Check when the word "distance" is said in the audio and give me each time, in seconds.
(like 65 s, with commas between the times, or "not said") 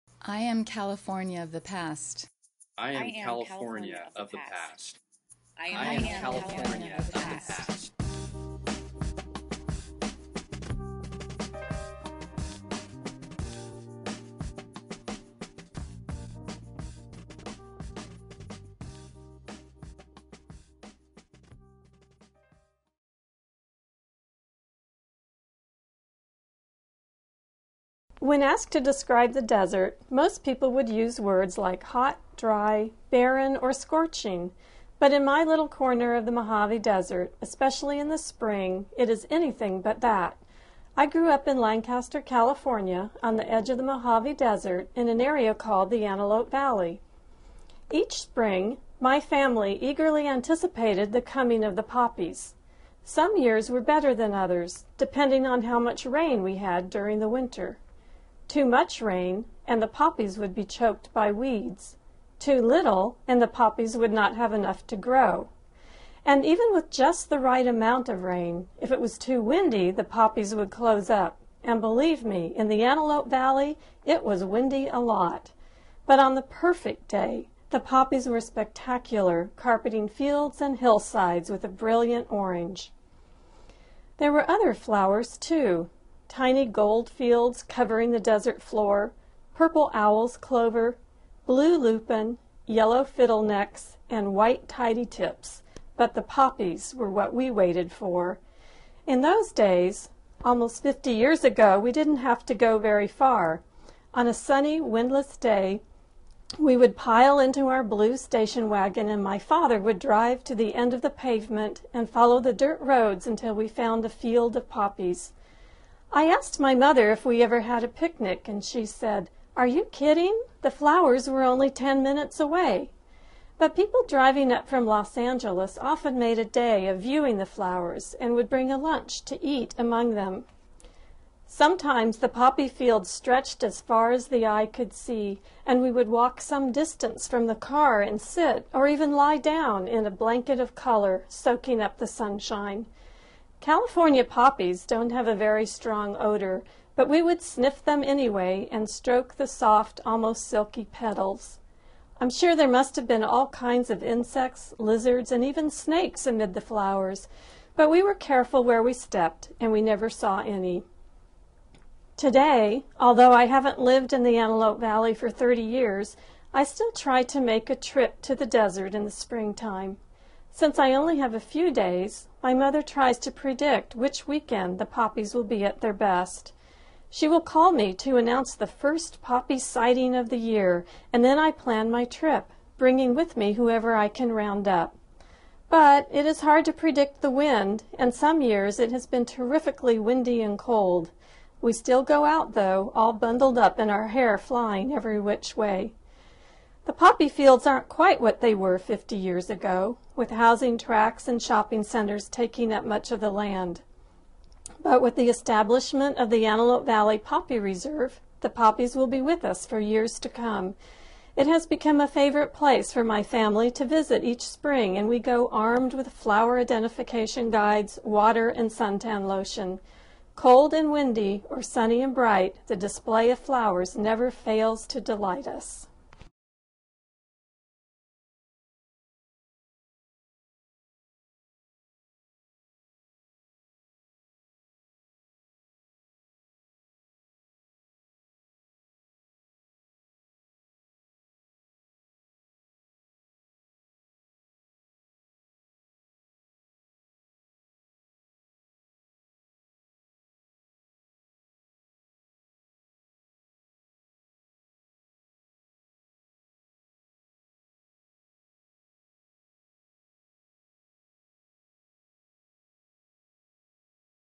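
136 s.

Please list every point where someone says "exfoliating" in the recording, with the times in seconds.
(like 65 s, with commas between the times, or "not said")
not said.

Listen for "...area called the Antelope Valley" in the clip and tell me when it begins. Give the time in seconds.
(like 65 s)
45 s.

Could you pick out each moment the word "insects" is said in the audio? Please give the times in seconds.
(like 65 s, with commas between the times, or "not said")
154 s.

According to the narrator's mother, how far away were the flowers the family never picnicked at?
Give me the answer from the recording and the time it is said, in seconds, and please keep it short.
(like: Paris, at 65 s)
10 minutes, at 121 s.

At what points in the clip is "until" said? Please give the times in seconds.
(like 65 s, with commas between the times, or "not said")
113 s.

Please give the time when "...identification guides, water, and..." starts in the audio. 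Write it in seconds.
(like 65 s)
216 s.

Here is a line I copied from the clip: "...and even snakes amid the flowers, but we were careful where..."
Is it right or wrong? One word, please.
right.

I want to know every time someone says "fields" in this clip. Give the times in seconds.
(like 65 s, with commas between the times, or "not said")
80 s, 87 s, 114 s, 132 s, 197 s.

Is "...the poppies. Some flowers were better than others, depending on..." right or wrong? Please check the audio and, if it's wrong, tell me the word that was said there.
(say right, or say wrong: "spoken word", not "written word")
wrong: "years", not "flowers".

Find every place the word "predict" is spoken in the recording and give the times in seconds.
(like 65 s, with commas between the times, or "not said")
173 s, 186 s.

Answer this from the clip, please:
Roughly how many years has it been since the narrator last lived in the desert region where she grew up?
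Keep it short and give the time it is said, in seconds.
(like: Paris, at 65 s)
30 years, at 165 s.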